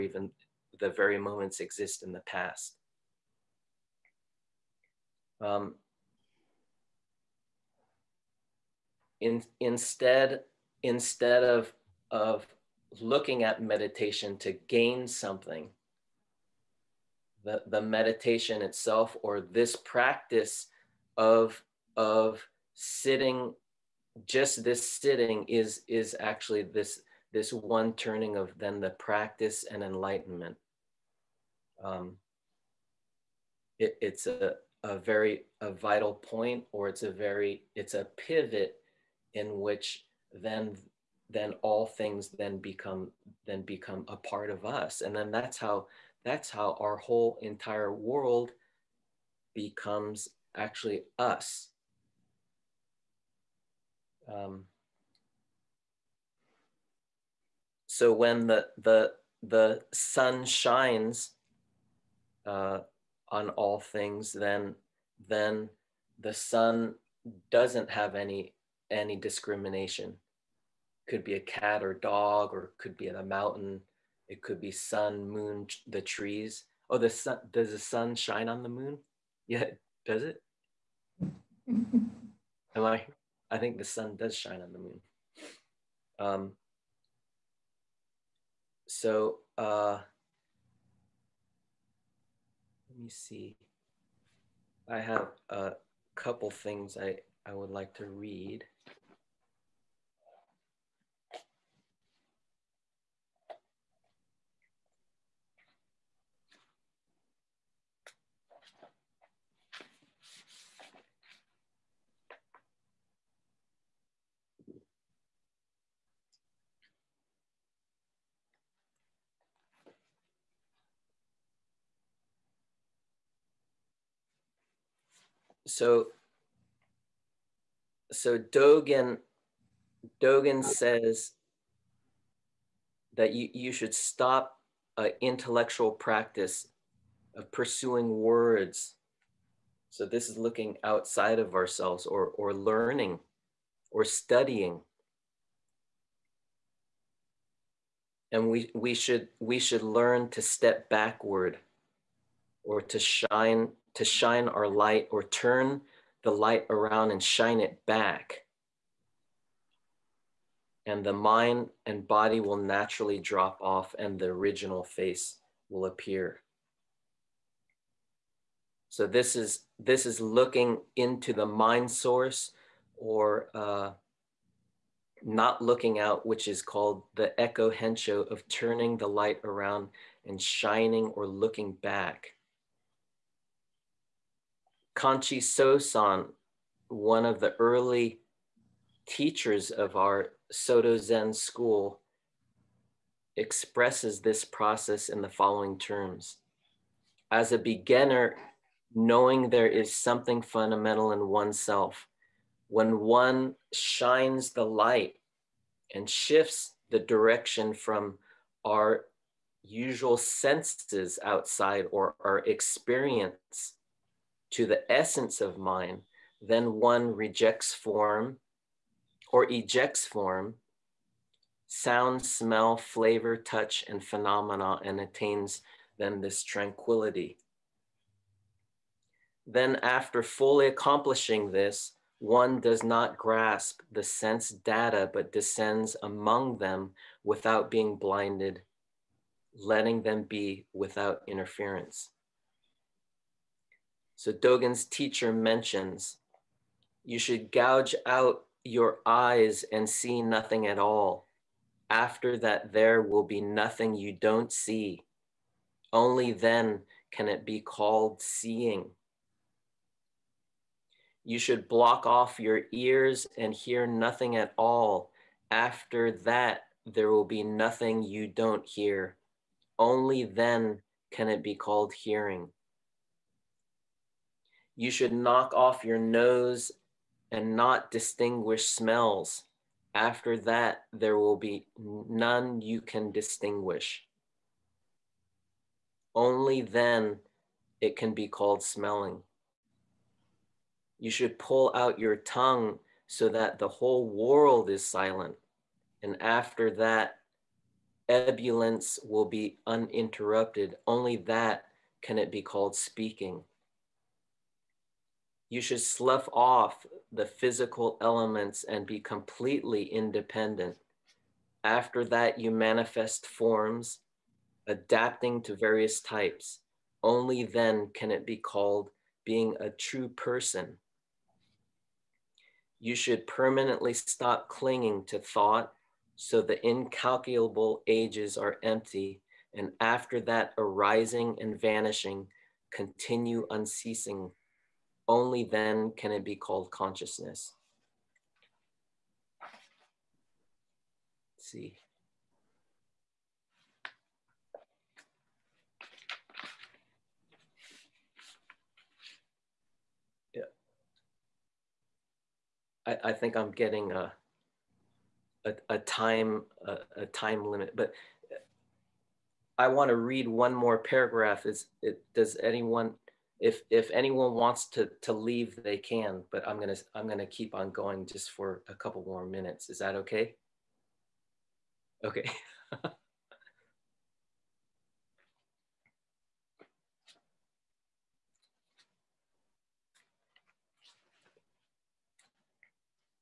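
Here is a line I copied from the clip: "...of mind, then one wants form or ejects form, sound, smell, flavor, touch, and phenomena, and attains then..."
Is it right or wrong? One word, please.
wrong.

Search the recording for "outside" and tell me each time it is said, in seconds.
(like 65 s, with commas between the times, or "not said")
140 s, 211 s.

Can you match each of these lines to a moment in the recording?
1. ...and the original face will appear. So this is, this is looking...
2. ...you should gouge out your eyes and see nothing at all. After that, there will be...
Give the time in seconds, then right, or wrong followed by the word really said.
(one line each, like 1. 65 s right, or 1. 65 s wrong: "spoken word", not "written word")
1. 163 s right
2. 247 s right.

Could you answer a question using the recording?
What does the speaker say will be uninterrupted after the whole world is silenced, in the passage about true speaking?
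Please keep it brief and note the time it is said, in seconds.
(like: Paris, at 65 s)
ebullience, at 298 s.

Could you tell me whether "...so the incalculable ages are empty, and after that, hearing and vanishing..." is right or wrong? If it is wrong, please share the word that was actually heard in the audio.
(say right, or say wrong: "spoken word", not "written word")
wrong: "arising", not "hearing".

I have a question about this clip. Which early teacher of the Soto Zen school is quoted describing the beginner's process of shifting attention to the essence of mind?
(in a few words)
Kanchi Sosan.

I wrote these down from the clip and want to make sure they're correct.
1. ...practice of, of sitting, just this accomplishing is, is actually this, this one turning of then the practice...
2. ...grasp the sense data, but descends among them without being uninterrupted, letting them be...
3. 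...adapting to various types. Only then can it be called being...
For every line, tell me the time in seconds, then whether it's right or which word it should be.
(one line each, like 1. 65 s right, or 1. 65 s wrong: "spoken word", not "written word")
1. 19 s wrong: "sitting", not "accomplishing"
2. 233 s wrong: "blinded", not "uninterrupted"
3. 314 s right.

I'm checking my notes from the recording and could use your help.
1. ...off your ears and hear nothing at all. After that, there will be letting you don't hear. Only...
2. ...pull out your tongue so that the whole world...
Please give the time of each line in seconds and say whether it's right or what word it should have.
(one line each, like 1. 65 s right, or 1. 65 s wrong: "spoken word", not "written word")
1. 262 s wrong: "nothing", not "letting"
2. 291 s right.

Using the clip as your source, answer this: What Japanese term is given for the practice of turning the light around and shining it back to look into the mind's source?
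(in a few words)
eko hensho.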